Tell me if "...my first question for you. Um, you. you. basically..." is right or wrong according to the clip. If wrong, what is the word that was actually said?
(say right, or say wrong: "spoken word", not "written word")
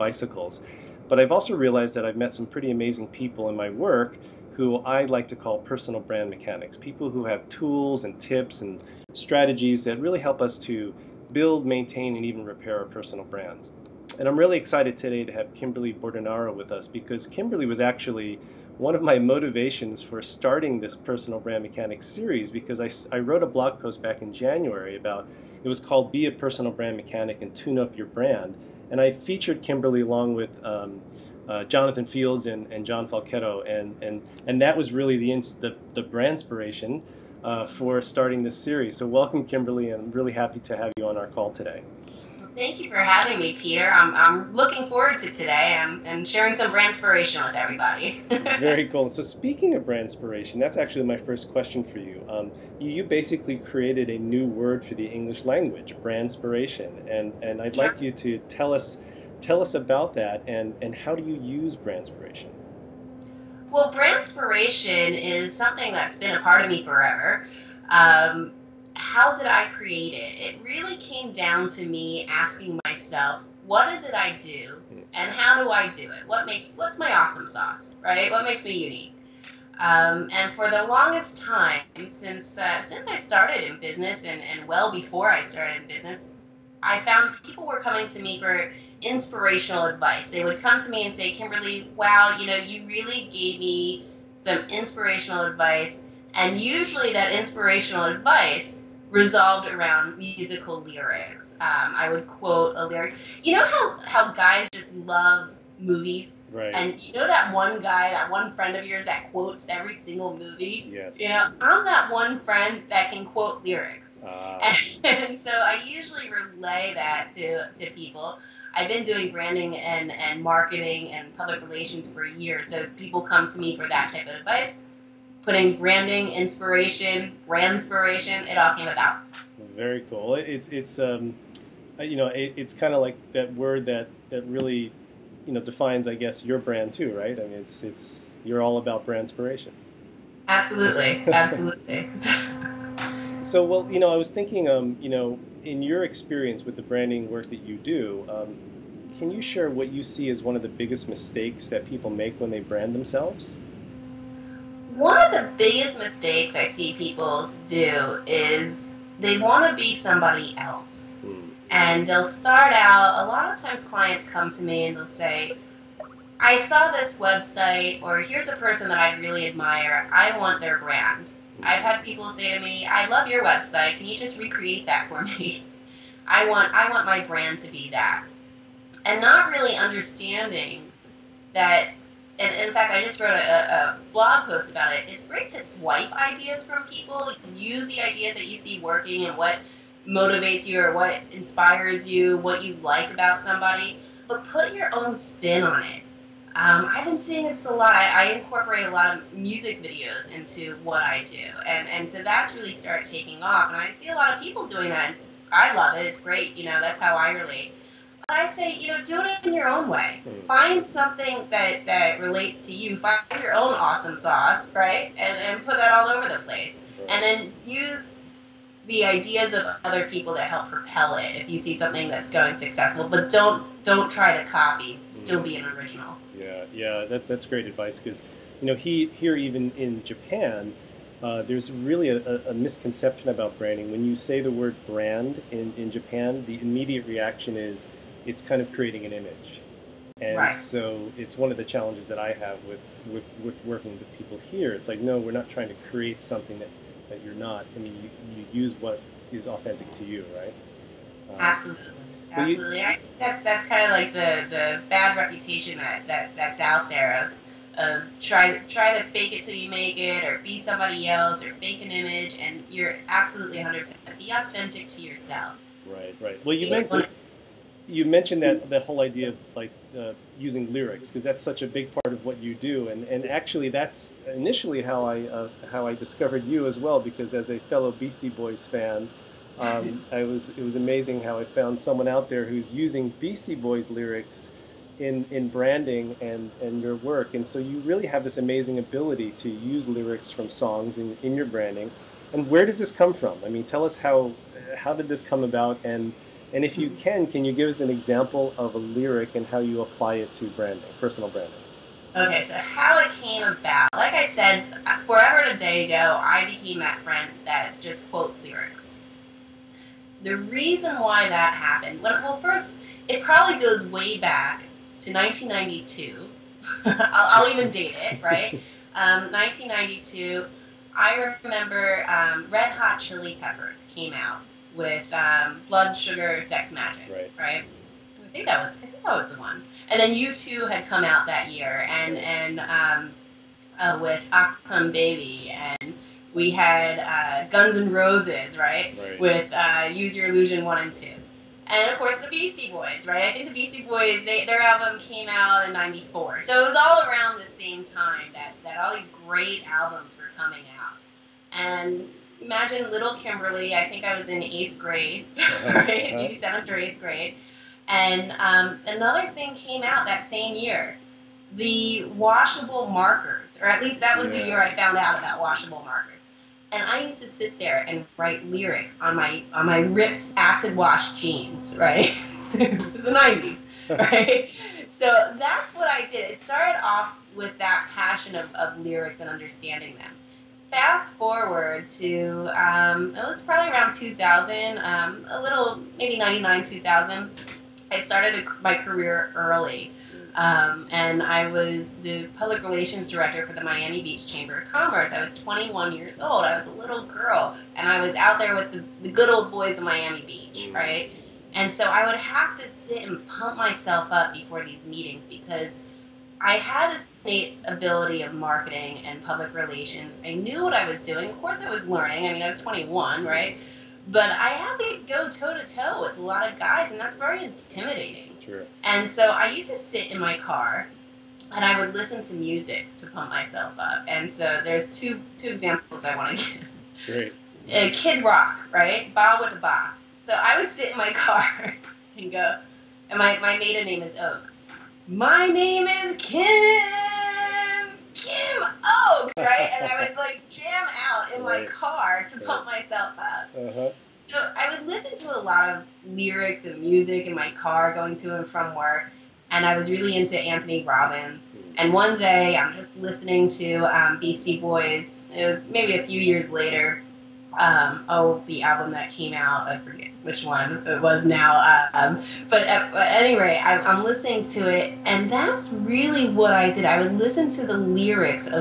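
right.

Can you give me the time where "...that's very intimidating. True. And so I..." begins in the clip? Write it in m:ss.
6:56.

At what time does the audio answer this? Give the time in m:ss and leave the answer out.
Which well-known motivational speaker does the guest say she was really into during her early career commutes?
7:30.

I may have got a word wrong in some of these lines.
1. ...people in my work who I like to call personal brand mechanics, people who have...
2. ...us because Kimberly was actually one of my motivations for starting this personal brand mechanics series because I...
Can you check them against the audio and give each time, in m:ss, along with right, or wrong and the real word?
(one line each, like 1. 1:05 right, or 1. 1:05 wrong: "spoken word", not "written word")
1. 0:03 right
2. 0:16 right.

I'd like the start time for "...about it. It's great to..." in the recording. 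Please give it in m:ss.
3:04.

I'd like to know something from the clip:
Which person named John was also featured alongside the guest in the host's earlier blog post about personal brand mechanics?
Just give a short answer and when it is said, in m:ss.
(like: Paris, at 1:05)
John Falchetto, at 0:32.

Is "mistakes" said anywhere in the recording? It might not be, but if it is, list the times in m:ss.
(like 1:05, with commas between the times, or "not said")
2:31, 2:35.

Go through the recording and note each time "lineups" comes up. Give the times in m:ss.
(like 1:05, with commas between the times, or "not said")
not said.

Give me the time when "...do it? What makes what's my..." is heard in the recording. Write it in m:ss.
1:15.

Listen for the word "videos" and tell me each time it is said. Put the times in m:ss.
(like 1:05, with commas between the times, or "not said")
3:19.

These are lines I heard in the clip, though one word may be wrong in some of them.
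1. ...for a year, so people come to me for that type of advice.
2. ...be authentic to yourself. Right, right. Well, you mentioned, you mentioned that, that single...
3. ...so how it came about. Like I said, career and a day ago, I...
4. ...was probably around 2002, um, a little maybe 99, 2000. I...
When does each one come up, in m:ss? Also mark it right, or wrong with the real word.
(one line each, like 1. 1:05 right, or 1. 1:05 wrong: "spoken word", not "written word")
1. 2:02 right
2. 4:24 wrong: "whole", not "single"
3. 5:02 wrong: "forever", not "career"
4. 6:23 wrong: "2000", not "2002".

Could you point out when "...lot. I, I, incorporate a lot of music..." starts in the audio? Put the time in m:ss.
3:17.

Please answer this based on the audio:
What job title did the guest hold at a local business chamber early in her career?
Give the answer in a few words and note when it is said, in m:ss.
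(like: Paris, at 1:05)
Public relations director, at 6:32.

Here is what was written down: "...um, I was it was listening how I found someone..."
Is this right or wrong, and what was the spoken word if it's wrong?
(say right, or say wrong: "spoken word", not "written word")
wrong: "amazing", not "listening".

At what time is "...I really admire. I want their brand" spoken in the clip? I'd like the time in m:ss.
2:48.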